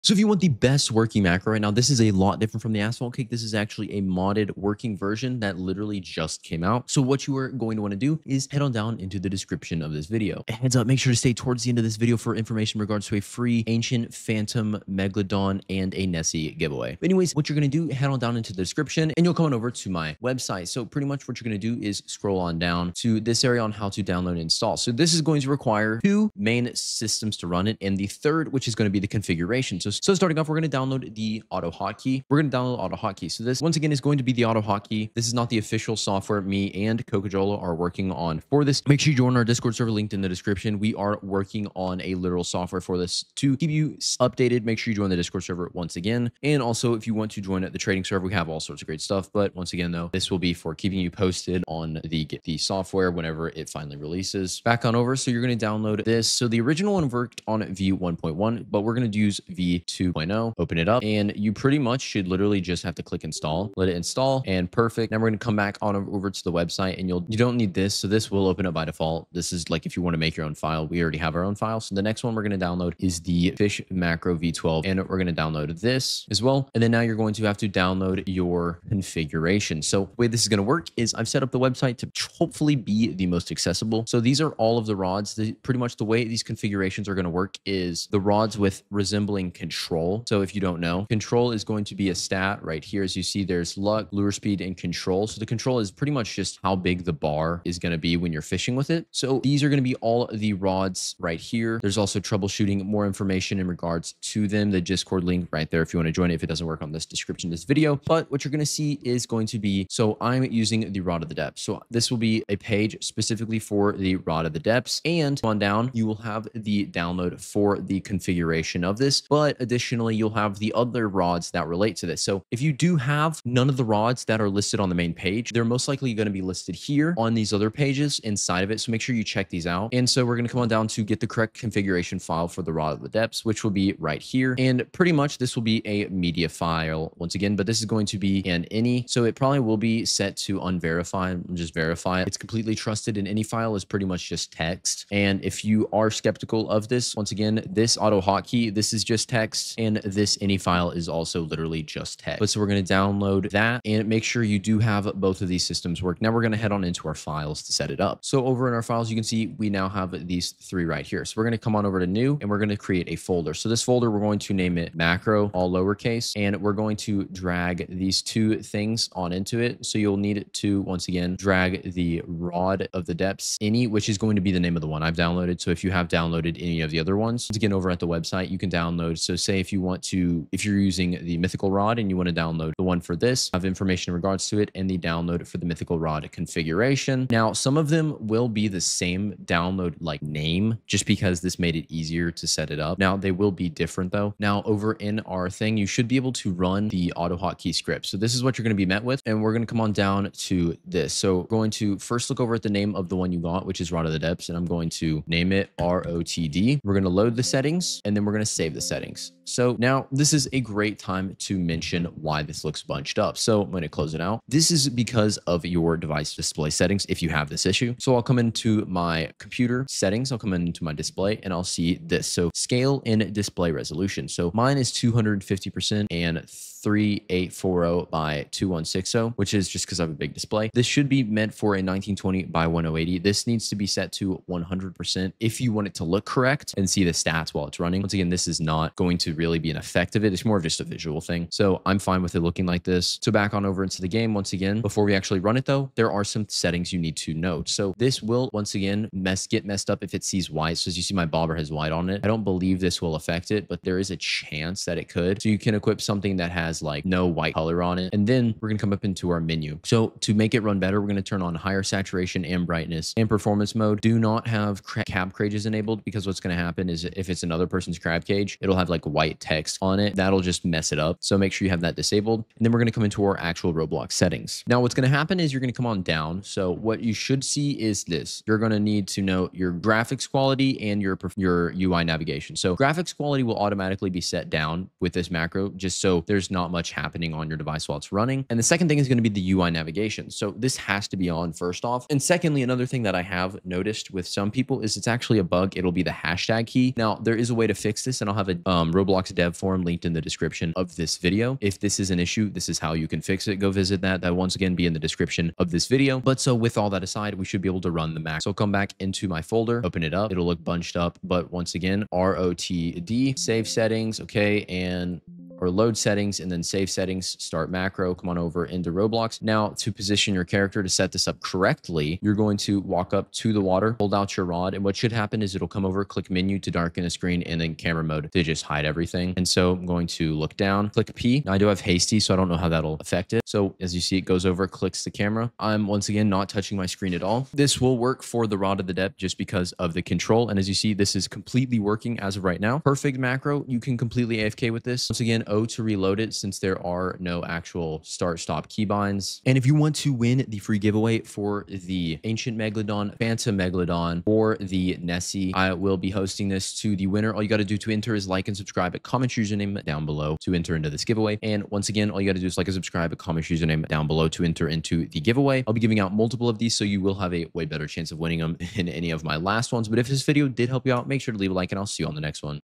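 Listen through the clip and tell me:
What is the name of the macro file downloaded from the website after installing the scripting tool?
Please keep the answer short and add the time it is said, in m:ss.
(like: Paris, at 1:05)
Fisch Macro V12, at 1:13.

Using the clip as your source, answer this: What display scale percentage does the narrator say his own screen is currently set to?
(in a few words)
250%.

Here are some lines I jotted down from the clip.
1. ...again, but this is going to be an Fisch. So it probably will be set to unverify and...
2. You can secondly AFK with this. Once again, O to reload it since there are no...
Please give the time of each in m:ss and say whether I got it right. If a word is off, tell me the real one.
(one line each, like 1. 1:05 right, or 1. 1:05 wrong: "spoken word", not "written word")
1. 2:17 wrong: "INI", not "Fisch"
2. 5:43 wrong: "completely", not "secondly".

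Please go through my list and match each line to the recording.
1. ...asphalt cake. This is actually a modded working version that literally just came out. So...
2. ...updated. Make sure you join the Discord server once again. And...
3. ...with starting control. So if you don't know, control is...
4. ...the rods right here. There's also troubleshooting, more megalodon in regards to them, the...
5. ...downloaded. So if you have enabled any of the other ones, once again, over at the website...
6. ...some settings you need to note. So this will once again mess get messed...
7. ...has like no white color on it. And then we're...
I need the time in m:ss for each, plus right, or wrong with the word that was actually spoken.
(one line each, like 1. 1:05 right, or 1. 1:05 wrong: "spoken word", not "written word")
1. 0:02 right
2. 0:44 right
3. 1:28 wrong: "resembling", not "starting"
4. 1:40 wrong: "information", not "megalodon"
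5. 2:55 wrong: "downloaded", not "enabled"
6. 4:06 right
7. 4:16 right.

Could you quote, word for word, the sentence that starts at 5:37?
This will work for the rod of the depth just because of the control.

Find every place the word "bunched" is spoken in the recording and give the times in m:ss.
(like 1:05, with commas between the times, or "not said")
3:32, 5:10.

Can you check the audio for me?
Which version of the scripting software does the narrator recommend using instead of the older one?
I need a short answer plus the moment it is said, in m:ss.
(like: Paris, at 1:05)
V2.0, at 0:59.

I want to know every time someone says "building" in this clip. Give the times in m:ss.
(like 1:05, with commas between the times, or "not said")
not said.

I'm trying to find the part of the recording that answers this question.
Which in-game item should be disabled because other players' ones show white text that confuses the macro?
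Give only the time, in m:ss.
4:24.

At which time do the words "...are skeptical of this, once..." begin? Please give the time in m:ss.
2:25.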